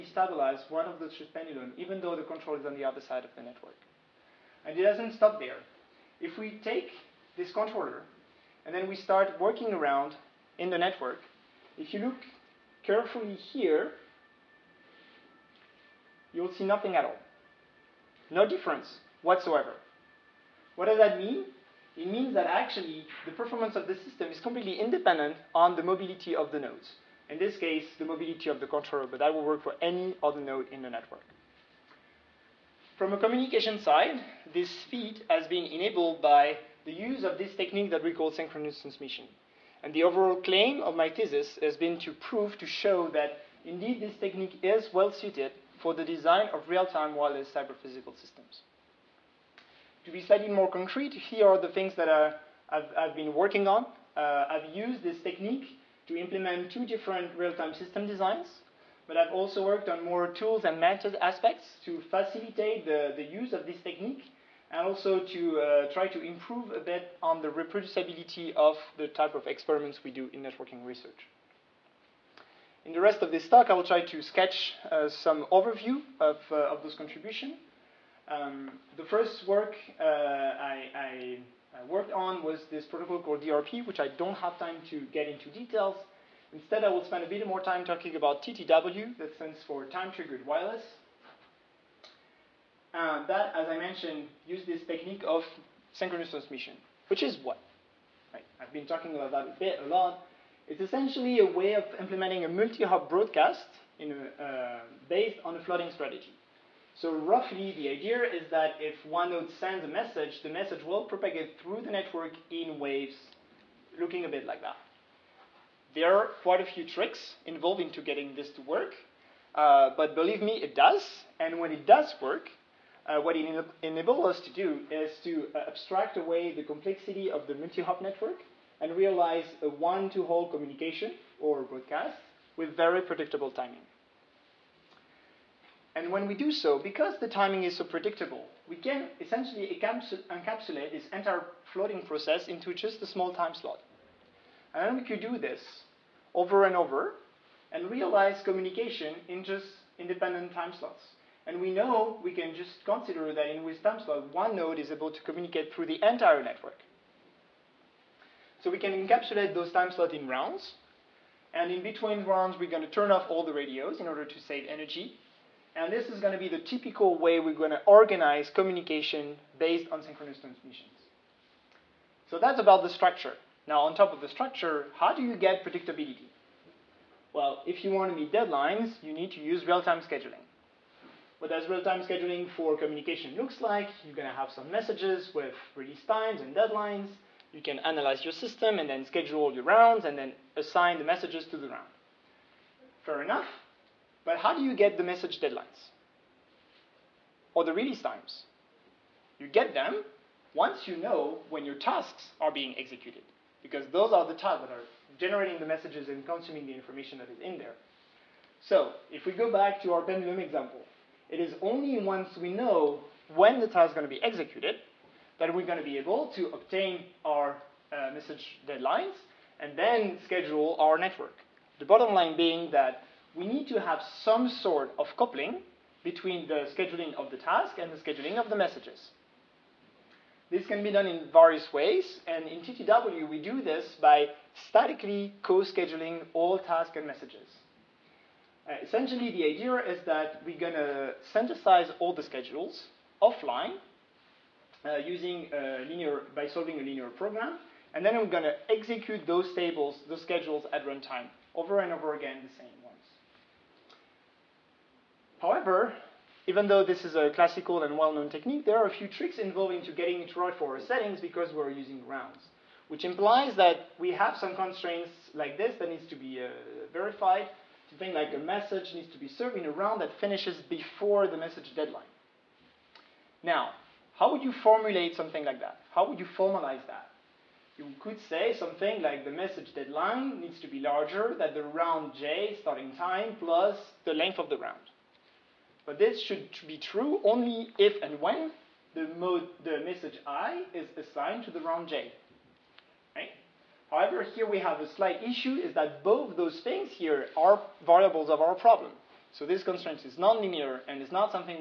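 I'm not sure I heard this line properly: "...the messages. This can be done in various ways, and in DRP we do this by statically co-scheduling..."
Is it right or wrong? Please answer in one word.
wrong.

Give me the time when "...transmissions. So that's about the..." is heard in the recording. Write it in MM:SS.
02:50.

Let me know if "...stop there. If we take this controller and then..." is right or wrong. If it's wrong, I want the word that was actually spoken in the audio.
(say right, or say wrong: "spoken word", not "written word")
right.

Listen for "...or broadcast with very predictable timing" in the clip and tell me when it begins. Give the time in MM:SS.
02:11.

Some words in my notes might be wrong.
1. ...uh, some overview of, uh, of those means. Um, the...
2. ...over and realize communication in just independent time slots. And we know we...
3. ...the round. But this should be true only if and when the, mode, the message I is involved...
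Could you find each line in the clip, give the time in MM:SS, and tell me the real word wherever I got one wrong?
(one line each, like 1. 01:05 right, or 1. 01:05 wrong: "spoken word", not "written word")
1. 01:14 wrong: "contributions", not "means"
2. 02:26 right
3. 04:44 wrong: "assigned", not "involved".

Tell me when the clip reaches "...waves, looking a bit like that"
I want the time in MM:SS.
01:52.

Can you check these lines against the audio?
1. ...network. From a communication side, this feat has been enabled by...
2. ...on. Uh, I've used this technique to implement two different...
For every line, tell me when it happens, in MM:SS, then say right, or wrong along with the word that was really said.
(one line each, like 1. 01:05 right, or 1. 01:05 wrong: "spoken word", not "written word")
1. 00:30 right
2. 00:53 right.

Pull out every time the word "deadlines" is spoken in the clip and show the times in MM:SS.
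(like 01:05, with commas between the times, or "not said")
02:58, 03:06, 03:15, 03:38, 04:31, 04:39.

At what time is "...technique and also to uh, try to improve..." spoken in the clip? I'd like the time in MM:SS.
01:03.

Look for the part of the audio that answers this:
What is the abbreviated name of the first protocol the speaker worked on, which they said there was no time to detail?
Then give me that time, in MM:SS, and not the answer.
01:23.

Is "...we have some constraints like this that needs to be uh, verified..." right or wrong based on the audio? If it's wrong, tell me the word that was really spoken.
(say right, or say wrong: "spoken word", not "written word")
right.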